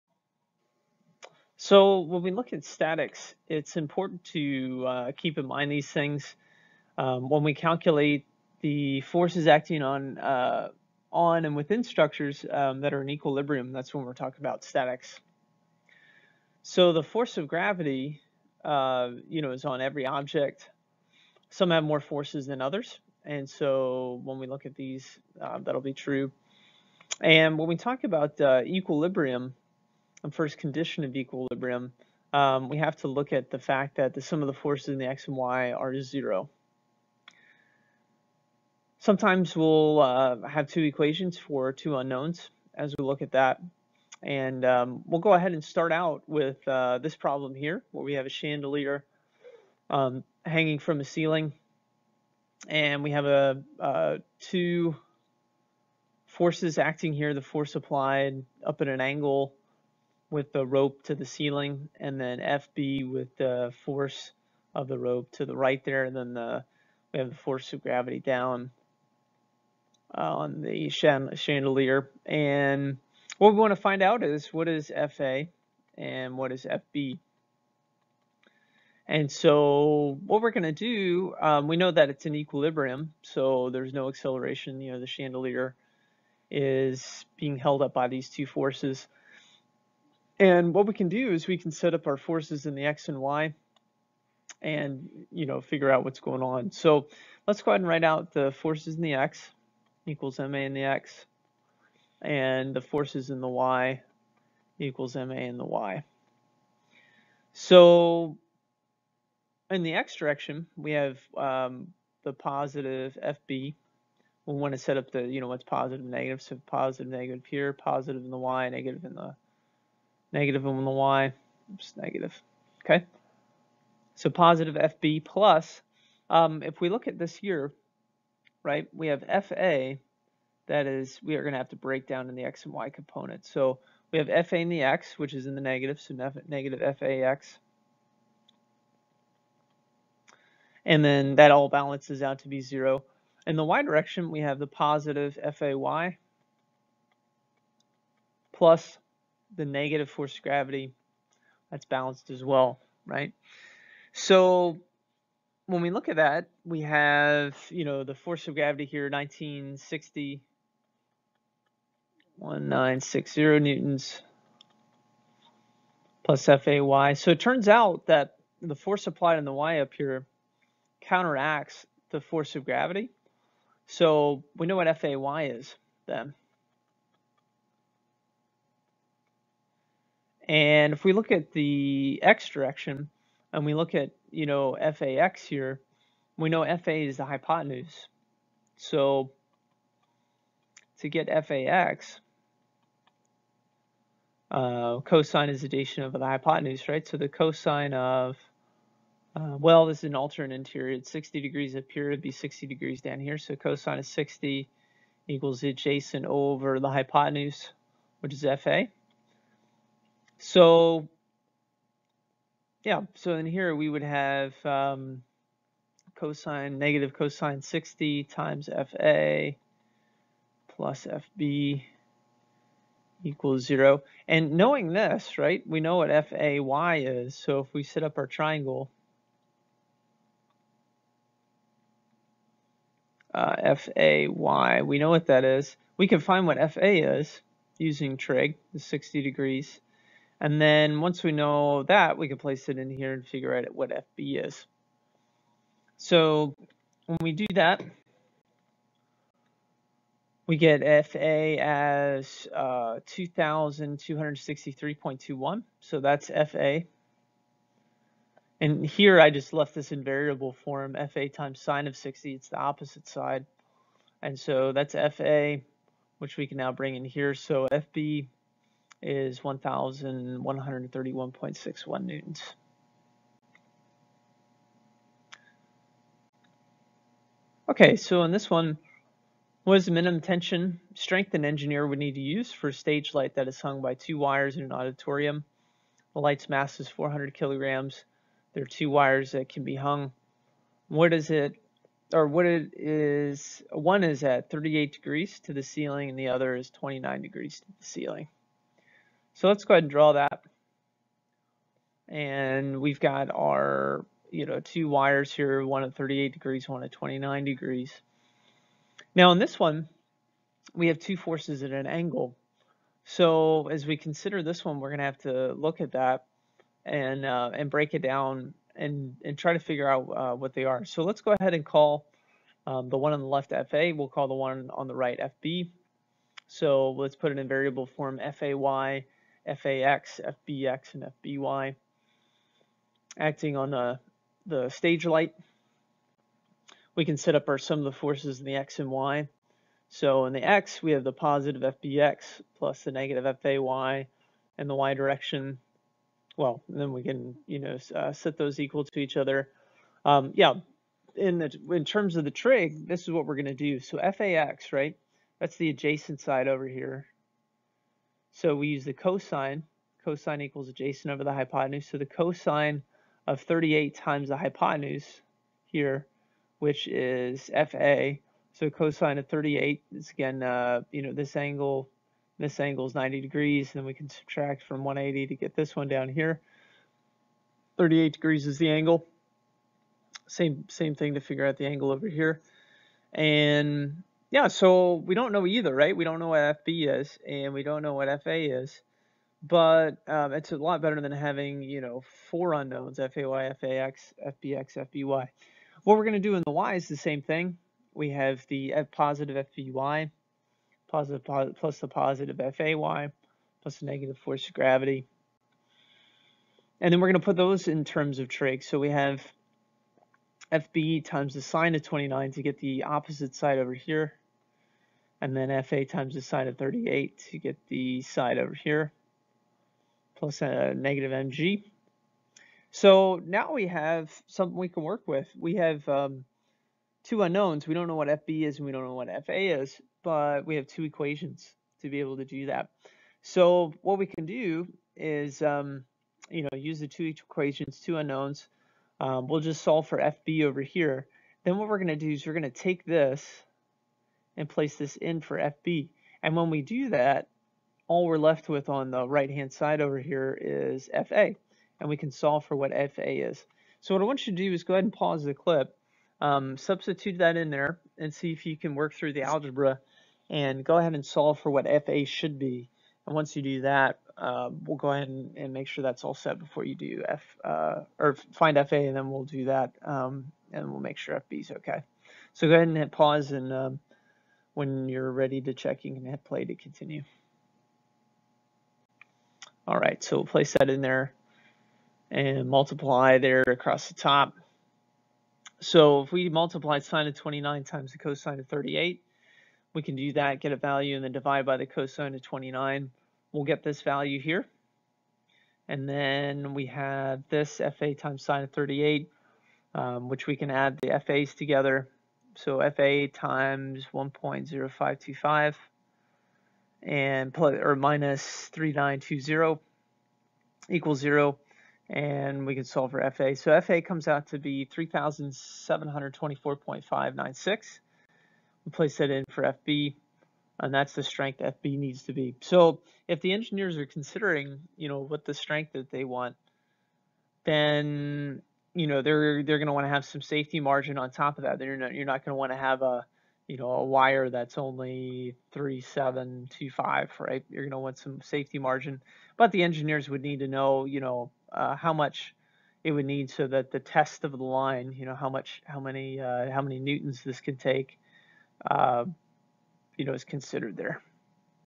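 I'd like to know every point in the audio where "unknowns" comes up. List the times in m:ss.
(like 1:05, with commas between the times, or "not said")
0:41, 6:32, 7:07, 7:17.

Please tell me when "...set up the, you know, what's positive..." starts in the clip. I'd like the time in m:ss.
1:54.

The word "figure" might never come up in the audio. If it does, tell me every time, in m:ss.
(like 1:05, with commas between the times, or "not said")
1:35, 4:03, 5:19, 6:21.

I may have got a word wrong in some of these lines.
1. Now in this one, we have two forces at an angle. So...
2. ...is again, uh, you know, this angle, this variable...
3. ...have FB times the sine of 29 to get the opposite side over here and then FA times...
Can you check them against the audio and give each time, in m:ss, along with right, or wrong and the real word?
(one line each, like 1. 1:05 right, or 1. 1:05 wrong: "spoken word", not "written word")
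1. 5:09 right
2. 6:09 wrong: "angle", not "variable"
3. 6:48 right.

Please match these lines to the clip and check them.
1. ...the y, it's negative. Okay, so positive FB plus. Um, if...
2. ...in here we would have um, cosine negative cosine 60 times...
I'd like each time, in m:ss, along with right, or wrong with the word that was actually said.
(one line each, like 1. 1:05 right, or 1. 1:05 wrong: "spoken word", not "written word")
1. 2:00 right
2. 3:33 right.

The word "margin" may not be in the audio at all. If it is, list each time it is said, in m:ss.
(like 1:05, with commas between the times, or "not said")
8:50, 8:58.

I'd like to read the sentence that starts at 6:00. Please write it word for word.
Cosine equals adjacent over the hypotenuse.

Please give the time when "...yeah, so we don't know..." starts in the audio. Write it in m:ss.
6:24.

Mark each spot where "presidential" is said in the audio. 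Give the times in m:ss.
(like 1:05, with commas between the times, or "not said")
not said.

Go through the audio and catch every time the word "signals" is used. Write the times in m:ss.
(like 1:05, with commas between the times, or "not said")
not said.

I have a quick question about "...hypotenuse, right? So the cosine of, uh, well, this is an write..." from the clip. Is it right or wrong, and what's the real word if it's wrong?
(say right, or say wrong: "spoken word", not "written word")
wrong: "alternate", not "write".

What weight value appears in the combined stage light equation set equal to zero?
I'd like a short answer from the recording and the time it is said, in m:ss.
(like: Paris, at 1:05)
3920, at 8:28.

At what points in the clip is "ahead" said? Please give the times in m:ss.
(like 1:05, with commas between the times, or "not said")
0:45, 1:37, 4:59, 5:21, 7:34, 7:40, 7:44, 7:52.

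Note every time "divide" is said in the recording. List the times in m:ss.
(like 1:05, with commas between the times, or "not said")
8:11.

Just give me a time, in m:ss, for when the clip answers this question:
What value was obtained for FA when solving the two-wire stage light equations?
8:34.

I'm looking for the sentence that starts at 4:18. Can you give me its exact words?
And here I just left this in variable form, FA times sine of 60.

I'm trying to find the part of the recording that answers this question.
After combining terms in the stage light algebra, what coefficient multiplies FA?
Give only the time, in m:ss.
8:23.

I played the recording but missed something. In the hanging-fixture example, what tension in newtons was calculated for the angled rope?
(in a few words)
2,263.21.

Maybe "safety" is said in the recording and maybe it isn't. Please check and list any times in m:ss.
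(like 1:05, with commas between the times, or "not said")
8:50, 8:58.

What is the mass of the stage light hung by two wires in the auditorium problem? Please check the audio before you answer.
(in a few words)
400 kilograms.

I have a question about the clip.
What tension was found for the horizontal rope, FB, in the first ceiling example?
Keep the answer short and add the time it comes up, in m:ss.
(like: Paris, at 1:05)
1,131.61 newtons, at 4:29.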